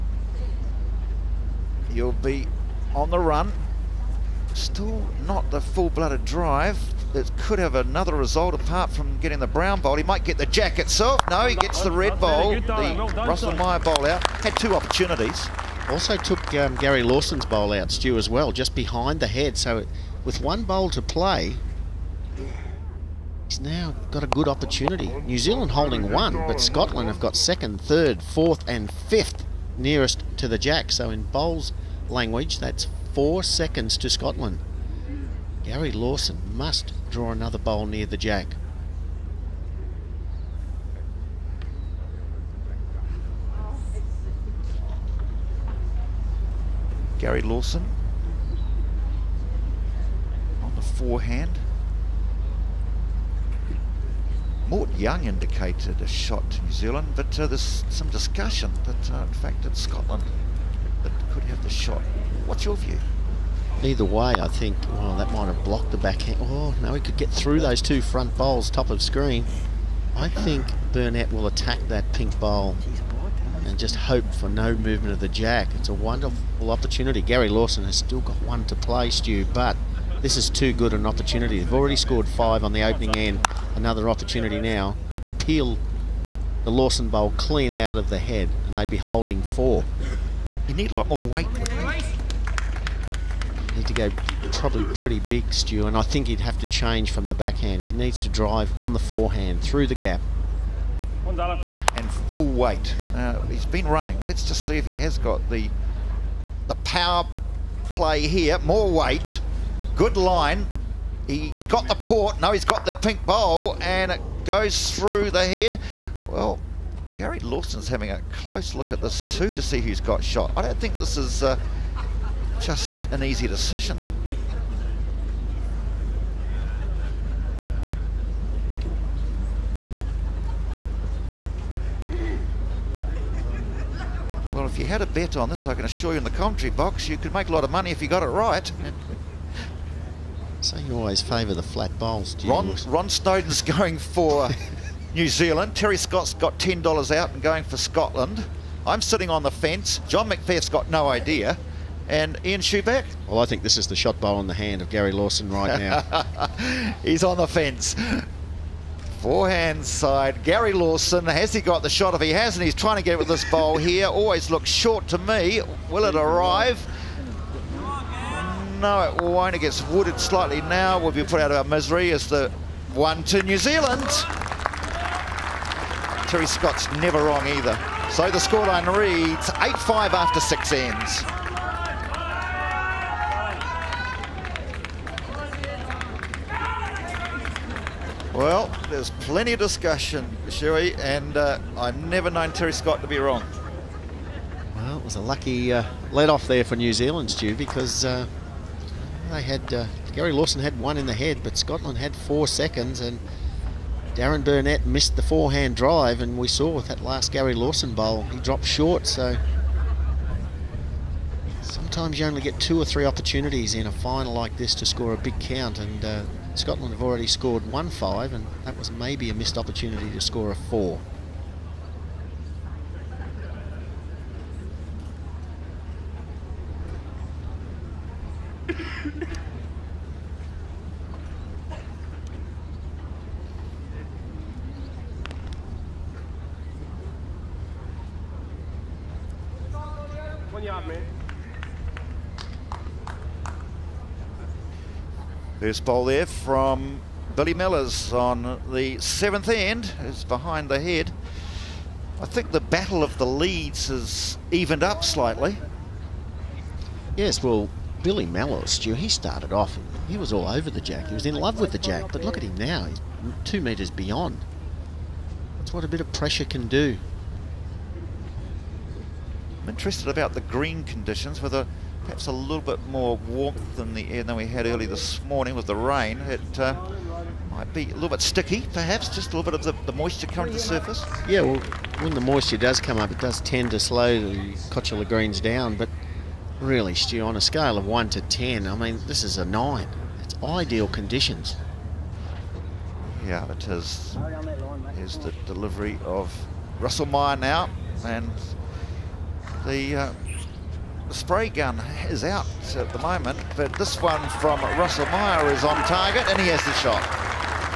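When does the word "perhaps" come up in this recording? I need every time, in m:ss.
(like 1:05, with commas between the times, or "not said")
4:32, 4:38.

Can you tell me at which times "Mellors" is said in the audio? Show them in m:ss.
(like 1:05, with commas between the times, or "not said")
4:07, 4:18.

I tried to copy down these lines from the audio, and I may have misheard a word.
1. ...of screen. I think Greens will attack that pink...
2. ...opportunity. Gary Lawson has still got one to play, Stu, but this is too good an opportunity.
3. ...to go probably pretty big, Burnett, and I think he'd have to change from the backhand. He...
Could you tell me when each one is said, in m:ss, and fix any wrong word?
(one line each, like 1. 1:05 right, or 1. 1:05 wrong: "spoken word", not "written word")
1. 1:08 wrong: "Burnett", not "Greens"
2. 1:16 right
3. 1:33 wrong: "Stu", not "Burnett".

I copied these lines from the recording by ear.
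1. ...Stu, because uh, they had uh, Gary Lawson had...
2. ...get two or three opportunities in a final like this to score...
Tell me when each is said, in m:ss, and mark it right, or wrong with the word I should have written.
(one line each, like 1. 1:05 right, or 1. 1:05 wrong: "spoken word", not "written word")
1. 3:17 right
2. 3:32 right.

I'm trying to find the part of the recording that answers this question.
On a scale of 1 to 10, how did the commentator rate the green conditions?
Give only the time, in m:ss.
4:49.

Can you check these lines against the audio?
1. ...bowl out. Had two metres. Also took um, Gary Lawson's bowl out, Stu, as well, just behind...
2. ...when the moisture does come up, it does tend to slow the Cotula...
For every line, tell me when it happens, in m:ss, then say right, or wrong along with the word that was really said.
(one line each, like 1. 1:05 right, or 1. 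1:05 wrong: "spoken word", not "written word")
1. 0:13 wrong: "opportunities", not "metres"
2. 4:42 right.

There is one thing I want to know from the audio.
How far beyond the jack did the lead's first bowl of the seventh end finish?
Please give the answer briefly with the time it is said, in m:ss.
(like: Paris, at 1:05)
2 metres, at 4:23.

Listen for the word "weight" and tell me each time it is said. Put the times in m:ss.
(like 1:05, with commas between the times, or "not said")
1:31, 1:42, 1:48.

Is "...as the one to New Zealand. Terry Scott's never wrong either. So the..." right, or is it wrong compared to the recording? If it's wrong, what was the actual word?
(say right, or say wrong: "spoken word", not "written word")
right.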